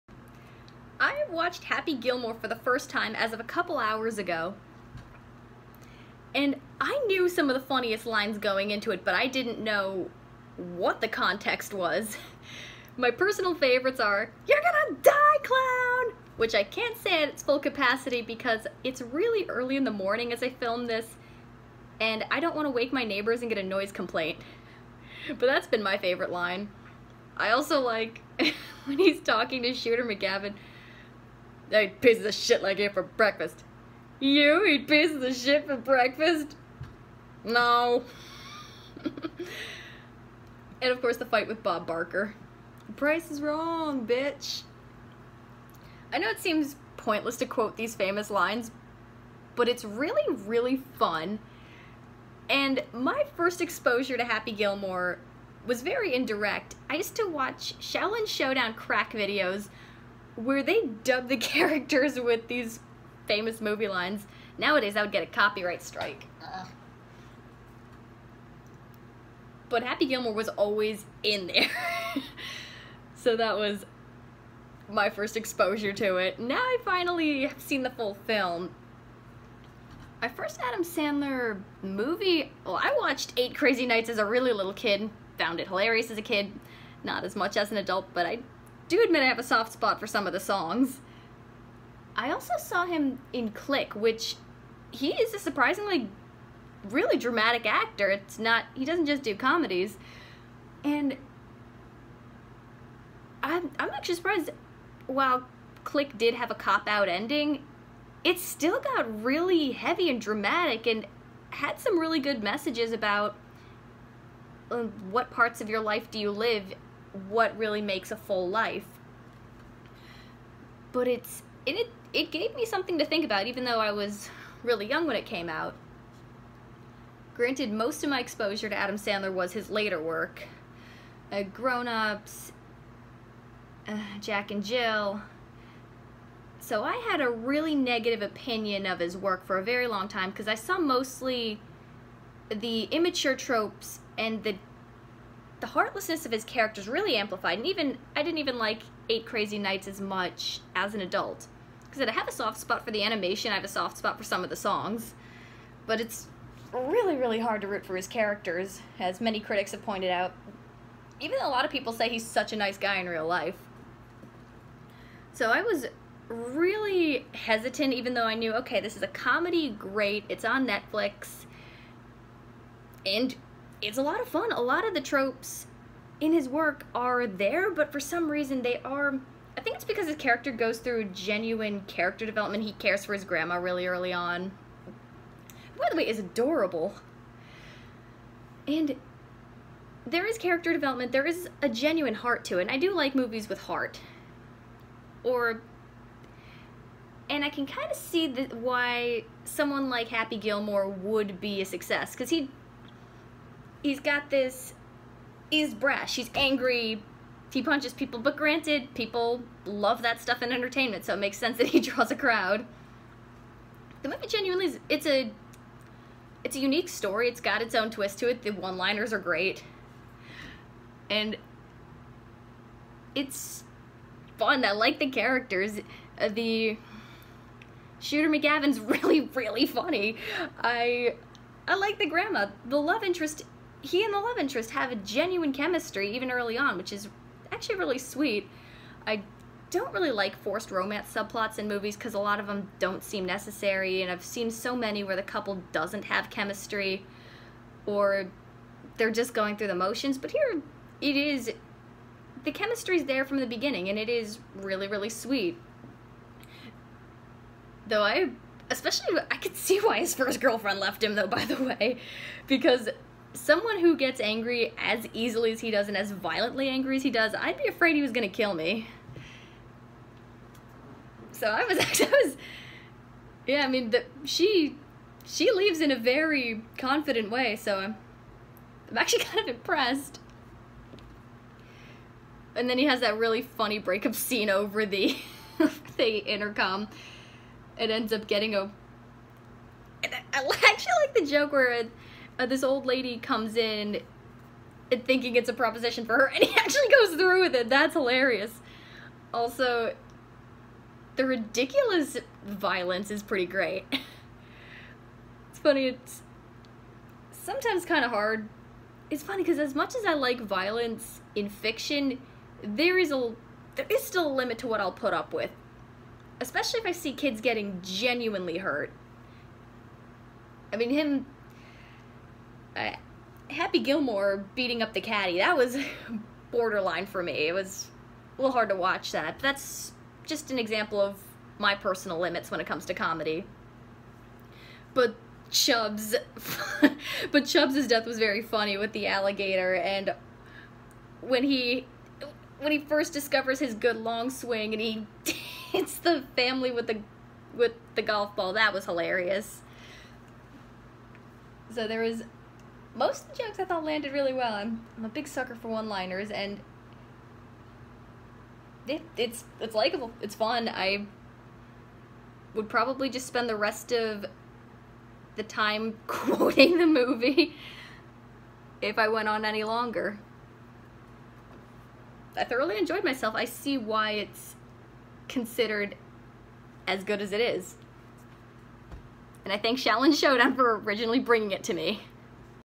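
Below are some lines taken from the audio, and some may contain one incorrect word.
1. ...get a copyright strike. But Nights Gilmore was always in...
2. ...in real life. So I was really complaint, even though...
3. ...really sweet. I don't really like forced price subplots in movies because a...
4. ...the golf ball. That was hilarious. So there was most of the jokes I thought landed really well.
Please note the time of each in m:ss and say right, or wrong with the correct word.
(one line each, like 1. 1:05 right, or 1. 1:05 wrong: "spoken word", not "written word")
1. 1:05 wrong: "Happy", not "Nights"
2. 2:42 wrong: "hesitant", not "complaint"
3. 3:57 wrong: "romance", not "price"
4. 5:47 right.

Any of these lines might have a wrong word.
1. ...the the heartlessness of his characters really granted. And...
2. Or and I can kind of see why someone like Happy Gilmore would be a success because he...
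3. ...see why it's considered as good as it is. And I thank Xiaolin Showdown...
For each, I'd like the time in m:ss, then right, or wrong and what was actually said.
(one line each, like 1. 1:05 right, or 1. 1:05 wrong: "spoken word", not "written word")
1. 2:24 wrong: "amplified", not "granted"
2. 3:15 right
3. 6:13 right.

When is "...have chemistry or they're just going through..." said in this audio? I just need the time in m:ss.
4:06.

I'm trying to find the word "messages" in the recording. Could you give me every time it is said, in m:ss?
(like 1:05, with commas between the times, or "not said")
1:52.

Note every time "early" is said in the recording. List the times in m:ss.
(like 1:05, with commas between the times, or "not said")
0:19, 3:03, 3:56.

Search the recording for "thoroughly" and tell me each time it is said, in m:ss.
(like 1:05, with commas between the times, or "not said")
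6:12.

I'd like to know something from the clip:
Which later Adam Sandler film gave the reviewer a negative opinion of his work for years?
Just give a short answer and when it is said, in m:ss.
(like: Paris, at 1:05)
Grown Ups, at 2:11.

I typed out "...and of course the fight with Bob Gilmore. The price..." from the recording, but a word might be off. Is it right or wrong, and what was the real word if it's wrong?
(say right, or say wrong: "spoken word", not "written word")
wrong: "Barker", not "Gilmore".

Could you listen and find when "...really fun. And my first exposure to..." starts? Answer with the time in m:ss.
0:50.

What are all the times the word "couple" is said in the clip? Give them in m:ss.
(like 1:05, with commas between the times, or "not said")
0:03, 4:05.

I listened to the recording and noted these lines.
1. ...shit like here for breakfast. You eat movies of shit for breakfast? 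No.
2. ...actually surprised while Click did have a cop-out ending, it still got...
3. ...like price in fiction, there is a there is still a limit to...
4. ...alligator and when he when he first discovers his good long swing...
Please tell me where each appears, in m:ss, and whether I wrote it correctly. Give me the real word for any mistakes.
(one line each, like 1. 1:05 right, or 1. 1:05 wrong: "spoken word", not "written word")
1. 0:32 wrong: "pieces", not "movies"
2. 1:43 right
3. 5:10 wrong: "violence", not "price"
4. 5:39 right.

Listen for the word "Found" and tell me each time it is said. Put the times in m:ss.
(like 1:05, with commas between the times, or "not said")
1:25.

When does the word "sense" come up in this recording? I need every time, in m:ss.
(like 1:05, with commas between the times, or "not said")
3:31.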